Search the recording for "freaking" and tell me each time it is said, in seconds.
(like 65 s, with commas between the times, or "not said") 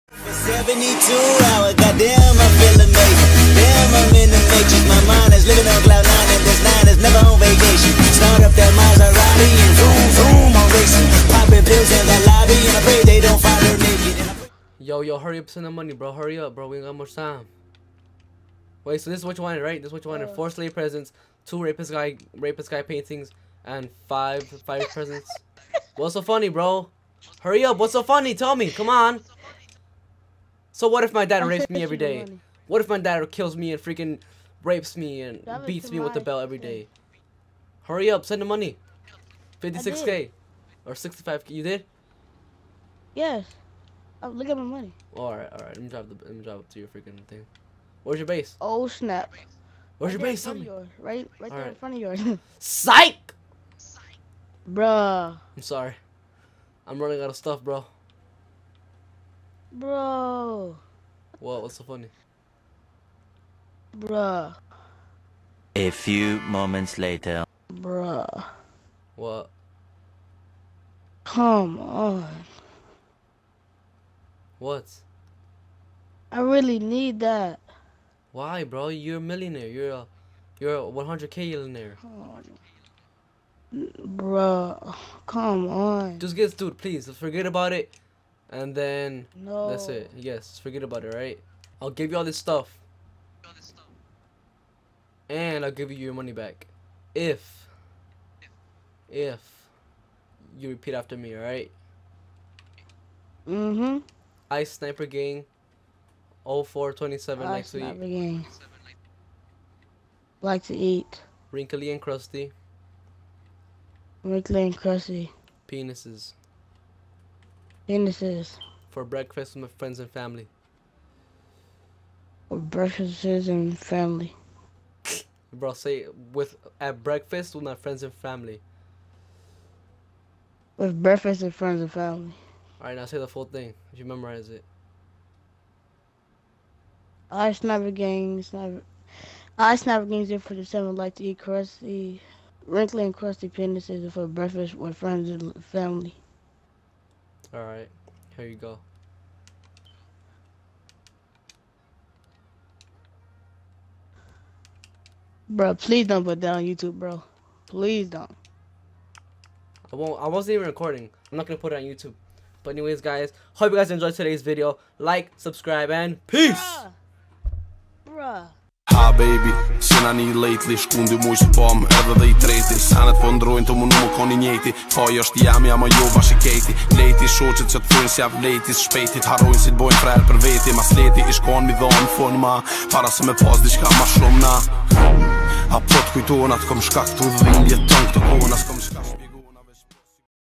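33 s, 46 s.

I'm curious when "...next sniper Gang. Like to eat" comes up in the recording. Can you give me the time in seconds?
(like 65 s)
107 s.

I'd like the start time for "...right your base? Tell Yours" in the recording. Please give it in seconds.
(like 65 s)
50 s.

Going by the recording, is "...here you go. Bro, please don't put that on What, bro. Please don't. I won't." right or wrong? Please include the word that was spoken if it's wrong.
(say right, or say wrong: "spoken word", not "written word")
wrong: "YouTube", not "What".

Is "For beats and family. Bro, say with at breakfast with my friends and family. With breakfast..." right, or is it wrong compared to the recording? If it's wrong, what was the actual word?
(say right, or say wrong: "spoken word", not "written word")
wrong: "breakfasts", not "beats".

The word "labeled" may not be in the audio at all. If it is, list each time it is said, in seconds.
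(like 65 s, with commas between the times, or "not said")
not said.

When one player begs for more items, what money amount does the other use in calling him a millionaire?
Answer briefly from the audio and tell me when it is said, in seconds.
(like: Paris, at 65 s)
100k, at 80 s.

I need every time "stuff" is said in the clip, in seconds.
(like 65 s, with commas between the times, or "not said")
57 s, 92 s.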